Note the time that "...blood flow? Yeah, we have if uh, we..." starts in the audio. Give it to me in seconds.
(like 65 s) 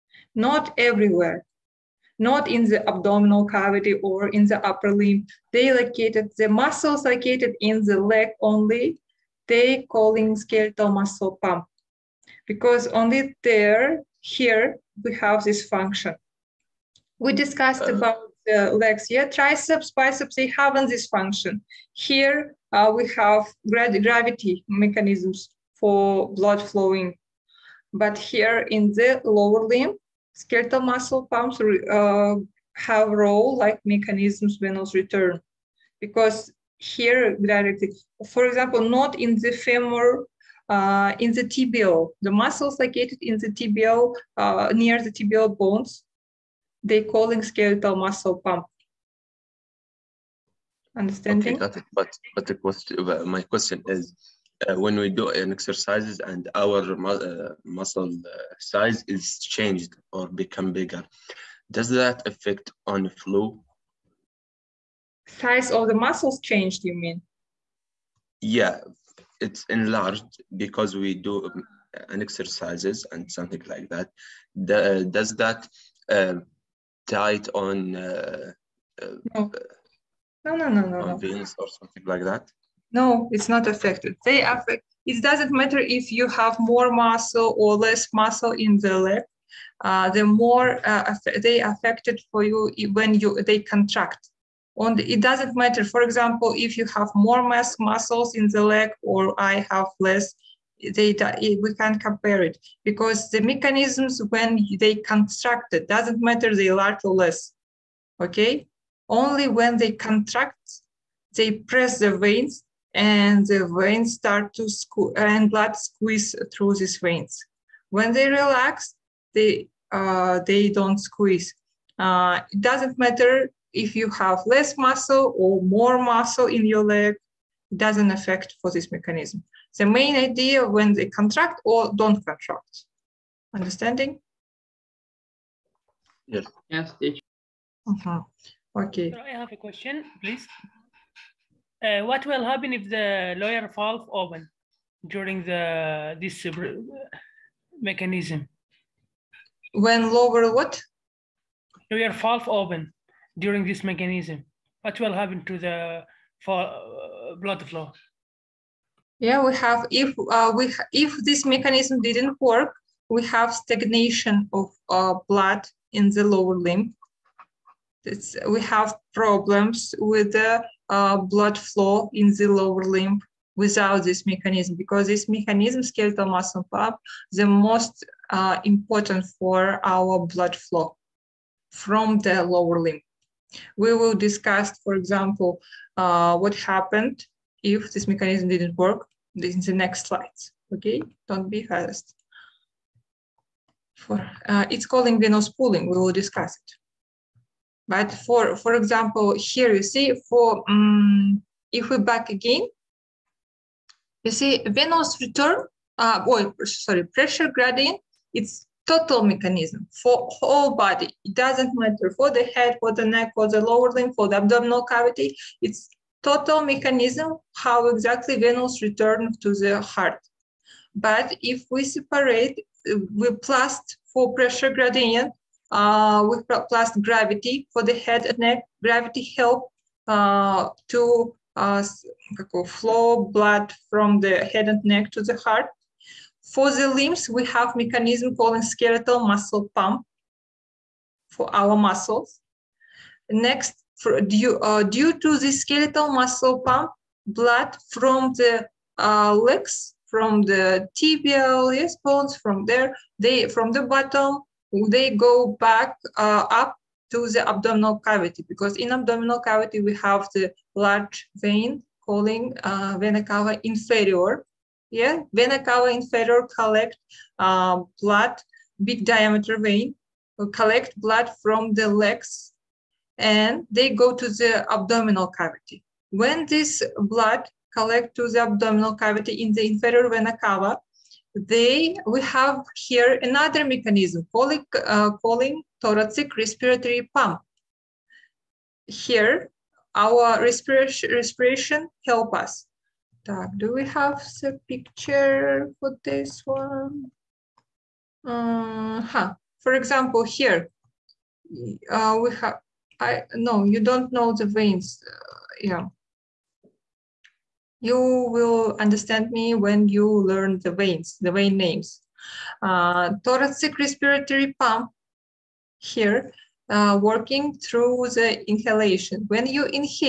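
157 s.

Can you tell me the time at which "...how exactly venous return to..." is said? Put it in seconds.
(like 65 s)
217 s.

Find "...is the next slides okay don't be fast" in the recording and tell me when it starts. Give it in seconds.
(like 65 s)
189 s.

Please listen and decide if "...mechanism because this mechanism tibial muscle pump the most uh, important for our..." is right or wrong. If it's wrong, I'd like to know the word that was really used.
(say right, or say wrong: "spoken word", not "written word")
wrong: "skeletal", not "tibial".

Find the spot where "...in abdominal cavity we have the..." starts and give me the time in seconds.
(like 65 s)
258 s.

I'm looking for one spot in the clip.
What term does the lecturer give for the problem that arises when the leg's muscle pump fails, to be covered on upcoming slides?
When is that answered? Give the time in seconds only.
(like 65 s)
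195 s.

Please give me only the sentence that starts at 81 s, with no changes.
veins or something like that no, it's not affected.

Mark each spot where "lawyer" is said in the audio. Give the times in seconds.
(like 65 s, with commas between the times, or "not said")
143 s, 151 s.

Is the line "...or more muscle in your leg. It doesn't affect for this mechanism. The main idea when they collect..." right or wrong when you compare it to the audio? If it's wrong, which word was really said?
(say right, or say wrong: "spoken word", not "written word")
wrong: "contract", not "collect".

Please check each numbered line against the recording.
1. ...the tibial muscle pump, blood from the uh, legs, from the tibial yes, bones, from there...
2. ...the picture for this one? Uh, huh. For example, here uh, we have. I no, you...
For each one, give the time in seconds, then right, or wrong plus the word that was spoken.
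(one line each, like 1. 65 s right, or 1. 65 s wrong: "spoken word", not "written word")
1. 245 s wrong: "skeletal", not "tibial"
2. 294 s right.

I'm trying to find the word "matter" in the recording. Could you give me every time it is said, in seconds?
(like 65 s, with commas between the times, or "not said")
85 s, 95 s, 106 s, 122 s, 211 s.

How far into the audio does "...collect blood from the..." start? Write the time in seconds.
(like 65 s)
270 s.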